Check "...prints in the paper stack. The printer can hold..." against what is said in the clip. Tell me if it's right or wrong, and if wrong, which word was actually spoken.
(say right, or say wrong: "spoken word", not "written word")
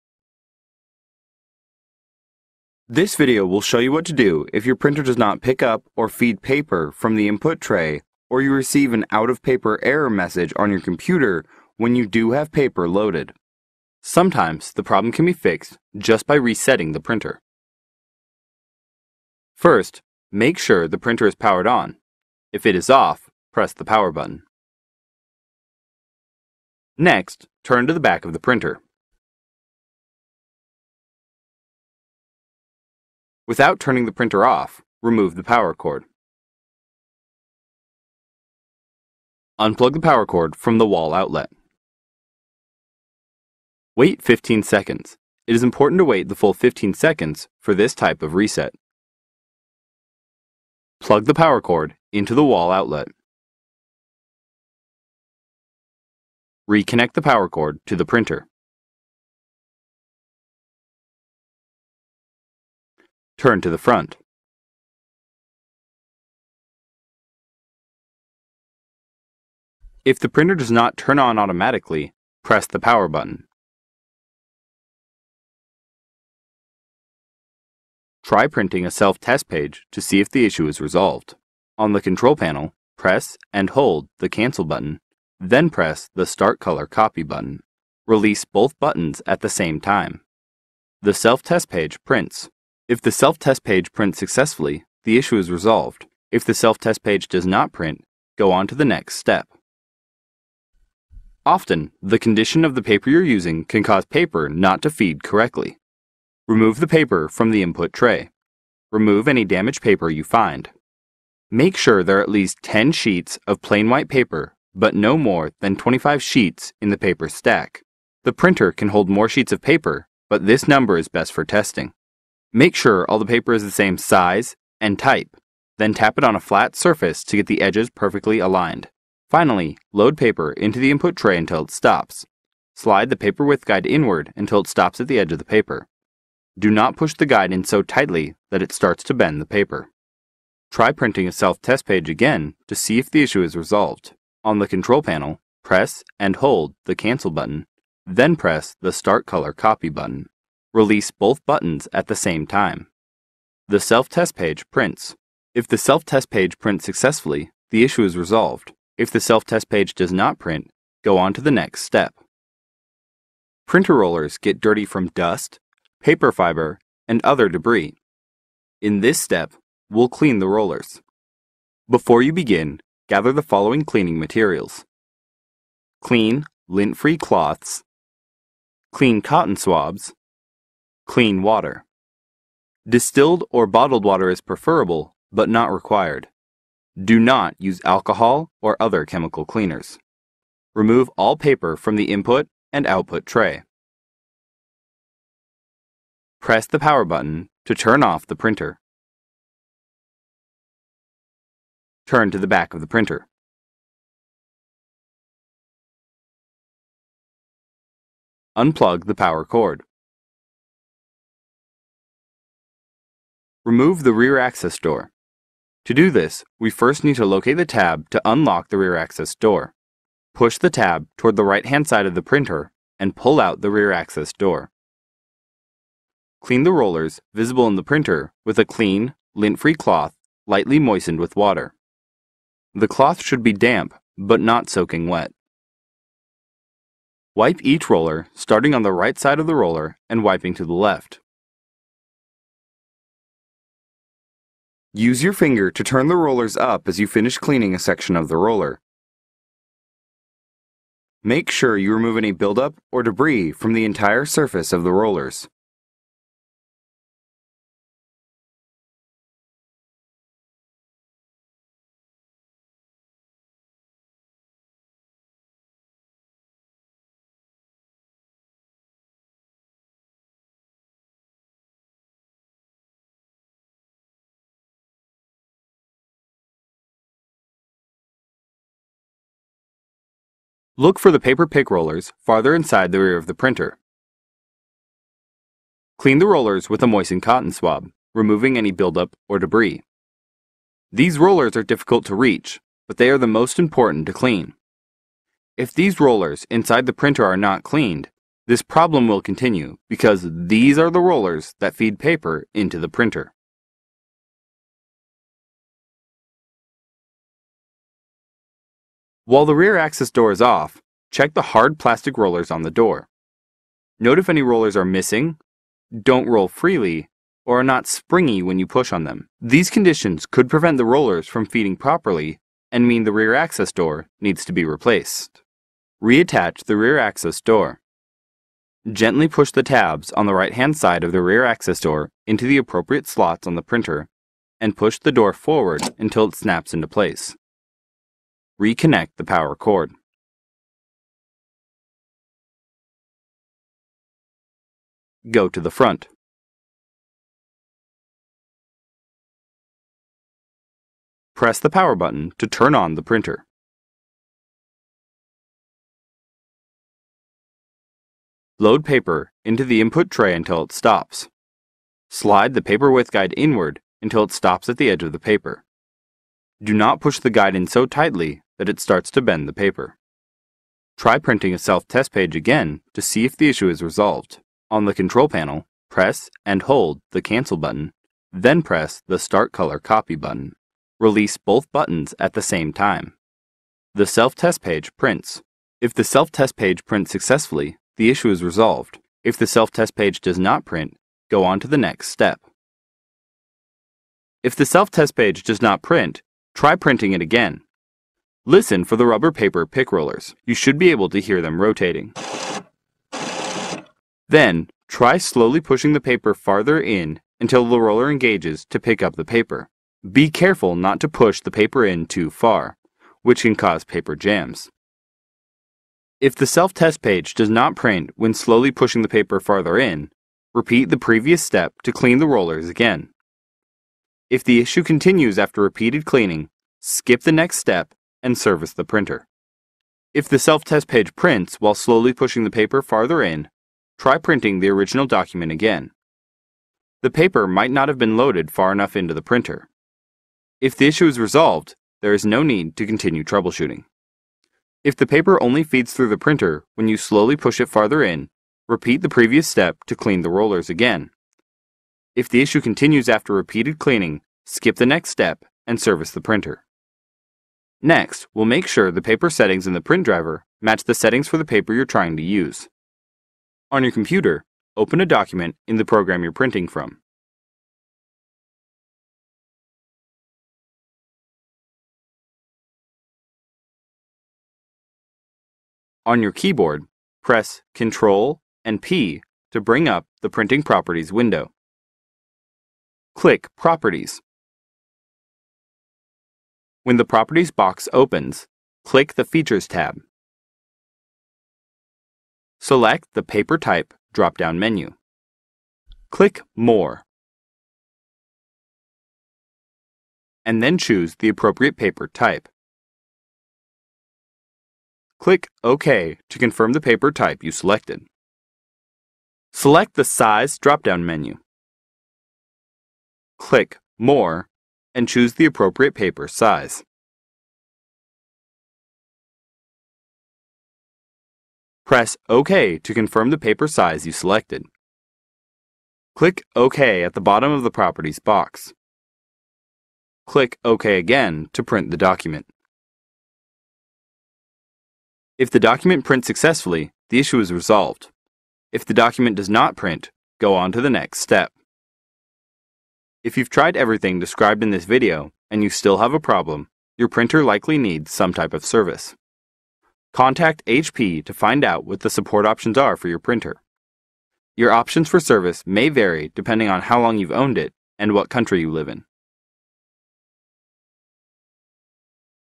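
wrong: "sheets", not "prints".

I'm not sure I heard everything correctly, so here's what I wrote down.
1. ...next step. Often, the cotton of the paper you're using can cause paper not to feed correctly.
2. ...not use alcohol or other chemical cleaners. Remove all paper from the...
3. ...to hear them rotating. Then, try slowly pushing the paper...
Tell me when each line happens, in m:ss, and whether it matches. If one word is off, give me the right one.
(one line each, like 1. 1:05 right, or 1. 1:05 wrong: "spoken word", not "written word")
1. 1:38 wrong: "condition", not "cotton"
2. 3:07 right
3. 6:41 right.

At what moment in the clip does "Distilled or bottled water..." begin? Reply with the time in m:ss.
3:02.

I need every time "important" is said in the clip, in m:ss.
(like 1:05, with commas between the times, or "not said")
0:45, 4:53.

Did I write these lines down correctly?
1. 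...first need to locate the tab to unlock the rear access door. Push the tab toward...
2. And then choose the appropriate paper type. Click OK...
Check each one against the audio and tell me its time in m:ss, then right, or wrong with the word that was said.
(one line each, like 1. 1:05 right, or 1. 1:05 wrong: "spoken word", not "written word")
1. 3:36 right
2. 8:20 right.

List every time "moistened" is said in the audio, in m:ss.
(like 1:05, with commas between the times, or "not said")
3:50, 4:46.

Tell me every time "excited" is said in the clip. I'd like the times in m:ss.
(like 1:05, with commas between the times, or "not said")
not said.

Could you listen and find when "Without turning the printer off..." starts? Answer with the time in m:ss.
0:33.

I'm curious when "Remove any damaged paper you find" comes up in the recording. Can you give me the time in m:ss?
1:48.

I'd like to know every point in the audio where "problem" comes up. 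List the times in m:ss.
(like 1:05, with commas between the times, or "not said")
0:14, 4:58, 9:06.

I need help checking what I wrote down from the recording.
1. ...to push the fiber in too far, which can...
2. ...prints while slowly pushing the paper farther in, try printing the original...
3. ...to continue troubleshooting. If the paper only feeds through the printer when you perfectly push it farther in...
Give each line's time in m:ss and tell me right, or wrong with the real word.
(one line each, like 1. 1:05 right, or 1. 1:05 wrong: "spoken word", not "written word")
1. 6:51 wrong: "paper", not "fiber"
2. 7:11 right
3. 7:22 wrong: "slowly", not "perfectly".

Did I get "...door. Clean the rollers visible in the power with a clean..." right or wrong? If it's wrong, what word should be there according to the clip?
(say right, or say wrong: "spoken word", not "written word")
wrong: "printer", not "power".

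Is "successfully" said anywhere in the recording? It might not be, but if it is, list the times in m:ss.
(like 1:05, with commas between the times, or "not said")
1:34, 2:36, 6:27, 8:56.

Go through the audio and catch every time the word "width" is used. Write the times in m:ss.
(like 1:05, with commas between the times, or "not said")
2:13, 6:02.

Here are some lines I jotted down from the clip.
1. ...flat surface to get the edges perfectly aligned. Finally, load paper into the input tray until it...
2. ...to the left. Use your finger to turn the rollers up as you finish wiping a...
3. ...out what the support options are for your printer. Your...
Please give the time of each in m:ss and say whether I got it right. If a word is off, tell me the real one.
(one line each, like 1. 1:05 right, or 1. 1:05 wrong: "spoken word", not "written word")
1. 2:06 right
2. 4:00 wrong: "cleaning", not "wiping"
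3. 9:11 right.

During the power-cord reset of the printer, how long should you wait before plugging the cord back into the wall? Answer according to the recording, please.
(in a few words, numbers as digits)
15 seconds.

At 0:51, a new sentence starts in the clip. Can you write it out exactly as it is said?
Plug the power cord into the wall outlet.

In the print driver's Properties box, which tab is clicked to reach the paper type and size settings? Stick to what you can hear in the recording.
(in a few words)
Features.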